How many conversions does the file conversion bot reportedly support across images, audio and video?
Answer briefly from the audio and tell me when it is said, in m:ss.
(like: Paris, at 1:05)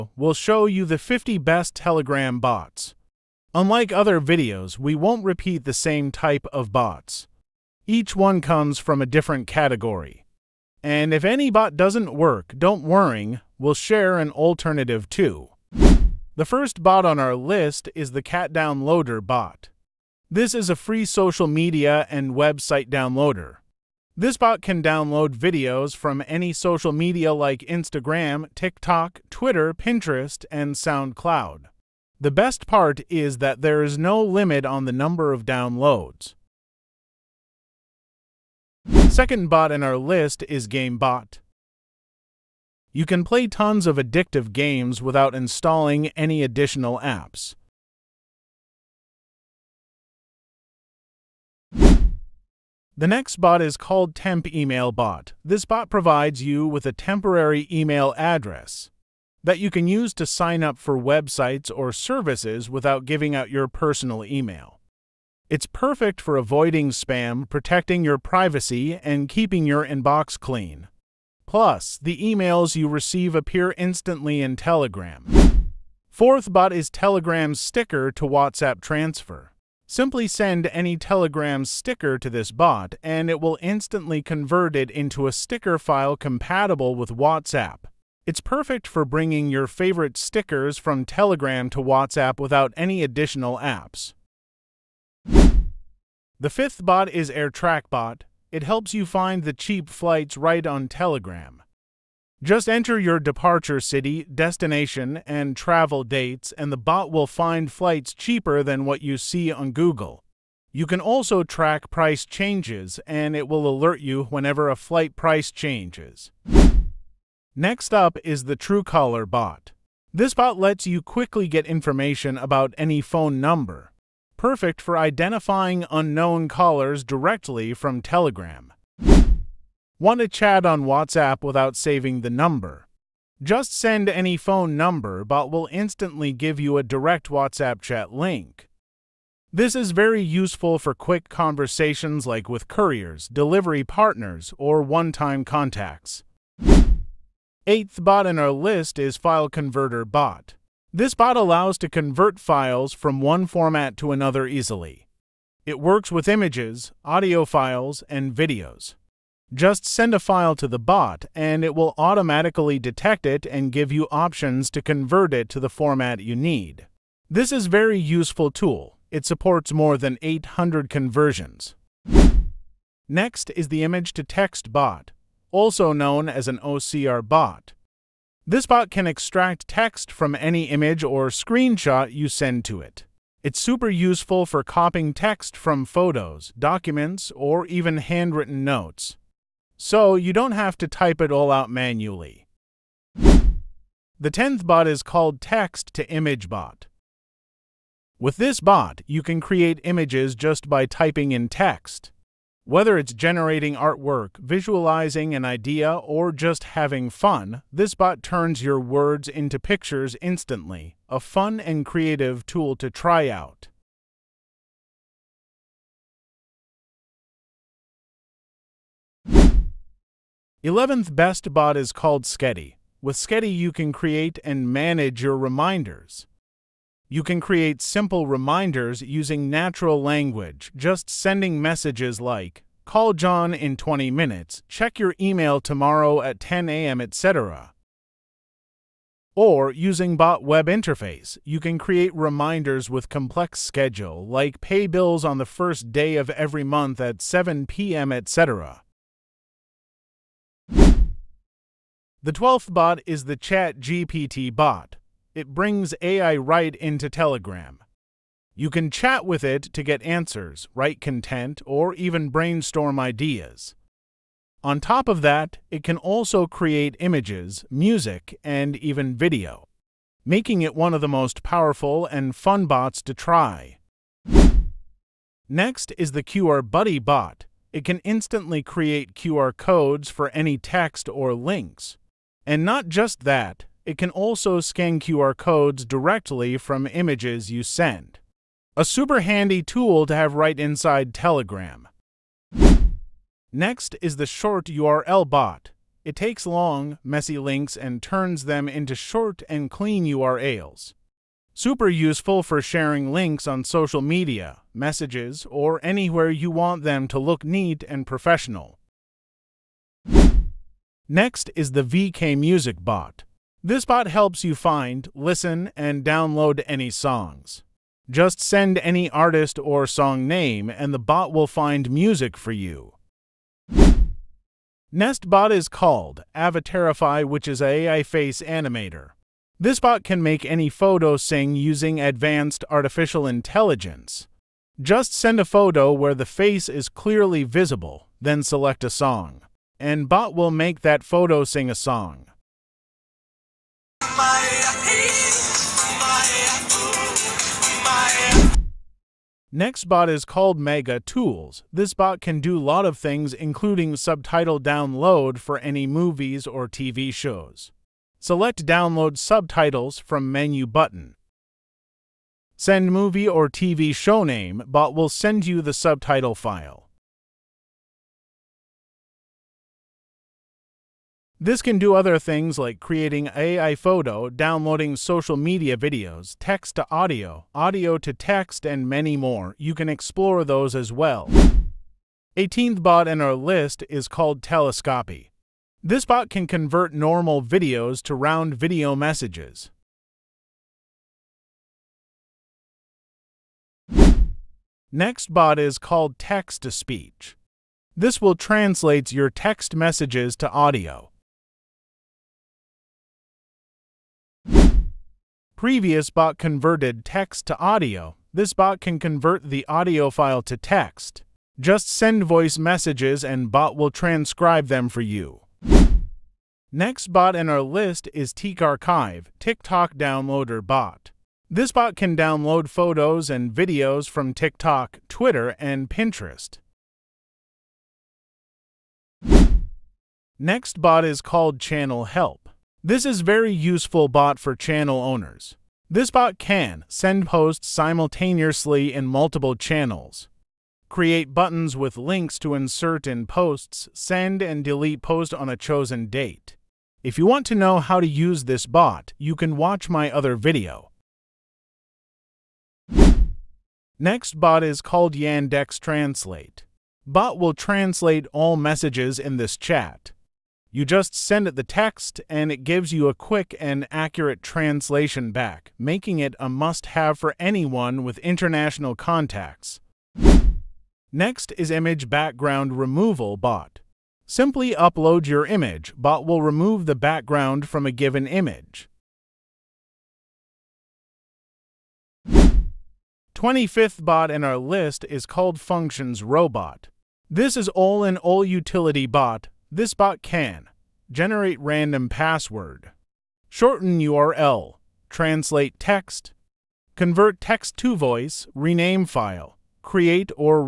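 More than 800, at 2:49.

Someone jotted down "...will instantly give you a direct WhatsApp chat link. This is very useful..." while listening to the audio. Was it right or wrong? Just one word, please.
right.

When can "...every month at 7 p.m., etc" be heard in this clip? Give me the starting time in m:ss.
4:06.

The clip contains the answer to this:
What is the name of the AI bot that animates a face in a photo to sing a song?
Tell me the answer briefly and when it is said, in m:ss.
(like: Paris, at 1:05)
Avatarify, at 5:26.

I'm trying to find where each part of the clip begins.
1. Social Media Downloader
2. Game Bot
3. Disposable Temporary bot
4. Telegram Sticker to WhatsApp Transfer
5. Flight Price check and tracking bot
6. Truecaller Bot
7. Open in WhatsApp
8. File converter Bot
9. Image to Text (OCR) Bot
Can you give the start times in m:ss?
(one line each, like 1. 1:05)
1. 0:16
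2. 0:38
3. 0:51
4. 1:15
5. 1:35
6. 1:56
7. 2:09
8. 2:26
9. 2:51.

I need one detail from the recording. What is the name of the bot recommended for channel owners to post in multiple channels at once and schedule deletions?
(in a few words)
Channel Help.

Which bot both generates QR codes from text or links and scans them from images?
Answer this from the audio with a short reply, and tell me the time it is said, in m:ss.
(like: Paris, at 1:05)
QR Buddy bot, at 4:36.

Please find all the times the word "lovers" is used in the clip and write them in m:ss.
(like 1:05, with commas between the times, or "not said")
not said.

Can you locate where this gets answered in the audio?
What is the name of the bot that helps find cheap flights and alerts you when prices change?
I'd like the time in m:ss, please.
1:37.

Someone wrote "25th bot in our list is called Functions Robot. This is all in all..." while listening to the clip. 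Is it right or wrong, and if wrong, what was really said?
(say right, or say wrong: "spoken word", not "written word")
right.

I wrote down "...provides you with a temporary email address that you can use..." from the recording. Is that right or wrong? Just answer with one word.
right.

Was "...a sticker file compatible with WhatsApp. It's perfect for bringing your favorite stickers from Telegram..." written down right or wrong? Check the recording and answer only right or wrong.
right.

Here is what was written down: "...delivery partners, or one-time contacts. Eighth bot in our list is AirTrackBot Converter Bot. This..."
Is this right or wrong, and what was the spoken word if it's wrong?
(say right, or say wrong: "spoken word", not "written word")
wrong: "File", not "AirTrackBot".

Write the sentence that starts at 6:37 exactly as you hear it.
This will translate your text messages to audio.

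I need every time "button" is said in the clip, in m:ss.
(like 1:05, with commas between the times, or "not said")
6:00, 7:21.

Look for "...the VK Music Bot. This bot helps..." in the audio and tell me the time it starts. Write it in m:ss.
5:11.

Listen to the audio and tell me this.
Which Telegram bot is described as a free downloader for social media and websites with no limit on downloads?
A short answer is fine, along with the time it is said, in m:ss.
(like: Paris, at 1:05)
Cat Downloader bot, at 0:18.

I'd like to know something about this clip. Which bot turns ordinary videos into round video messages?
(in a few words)
Telescopy.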